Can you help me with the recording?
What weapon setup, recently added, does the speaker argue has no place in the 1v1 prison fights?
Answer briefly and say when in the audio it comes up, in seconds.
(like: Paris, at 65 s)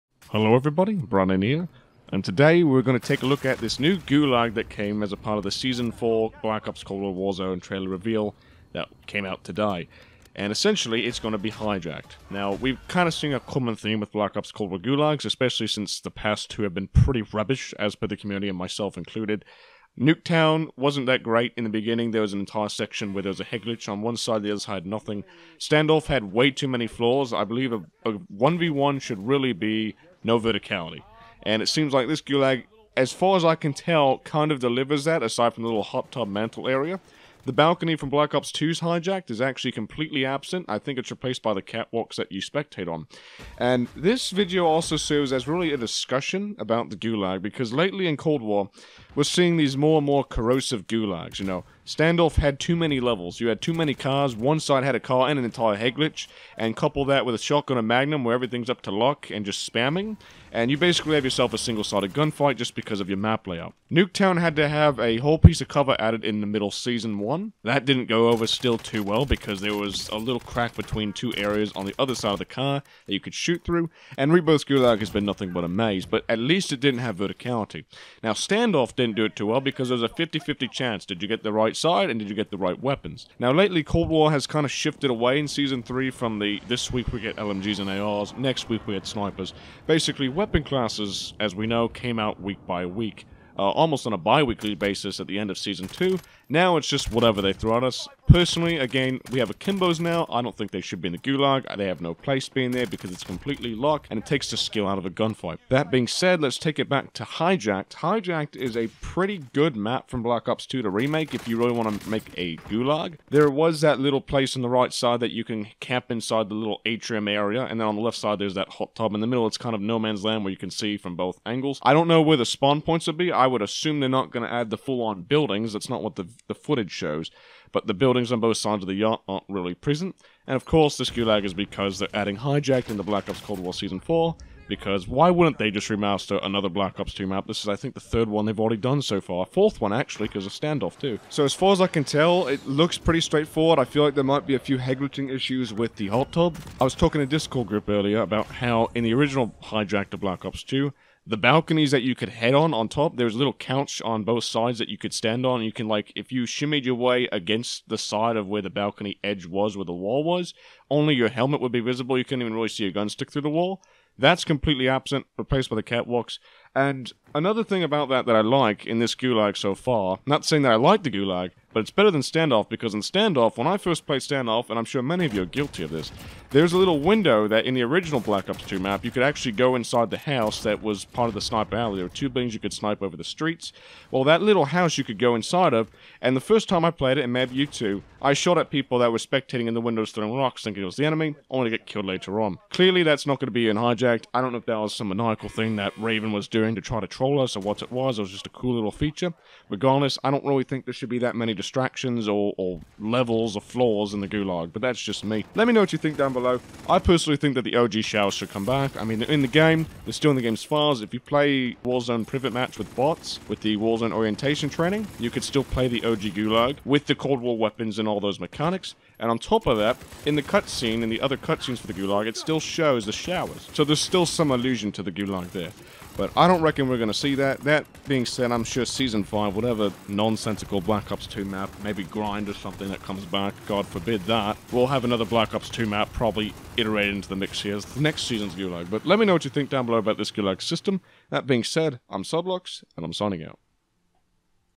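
Akimbos, at 99 s.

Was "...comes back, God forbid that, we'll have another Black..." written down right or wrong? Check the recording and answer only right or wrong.
right.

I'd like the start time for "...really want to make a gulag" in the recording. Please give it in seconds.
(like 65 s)
111 s.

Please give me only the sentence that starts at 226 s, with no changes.
But I don't reckon we're going to see that.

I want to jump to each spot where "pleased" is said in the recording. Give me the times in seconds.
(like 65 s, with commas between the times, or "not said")
not said.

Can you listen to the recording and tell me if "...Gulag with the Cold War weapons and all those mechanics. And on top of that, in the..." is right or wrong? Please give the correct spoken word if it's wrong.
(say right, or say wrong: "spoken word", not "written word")
right.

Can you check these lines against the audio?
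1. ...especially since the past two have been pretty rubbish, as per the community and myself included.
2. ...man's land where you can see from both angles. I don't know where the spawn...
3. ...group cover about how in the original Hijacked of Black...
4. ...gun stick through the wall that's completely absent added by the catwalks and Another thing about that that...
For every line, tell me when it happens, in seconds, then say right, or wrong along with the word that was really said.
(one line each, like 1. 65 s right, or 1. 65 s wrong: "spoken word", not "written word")
1. 15 s right
2. 119 s right
3. 147 s wrong: "earlier", not "cover"
4. 162 s wrong: "replaced", not "added".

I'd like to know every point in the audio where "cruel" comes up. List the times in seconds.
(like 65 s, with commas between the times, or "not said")
not said.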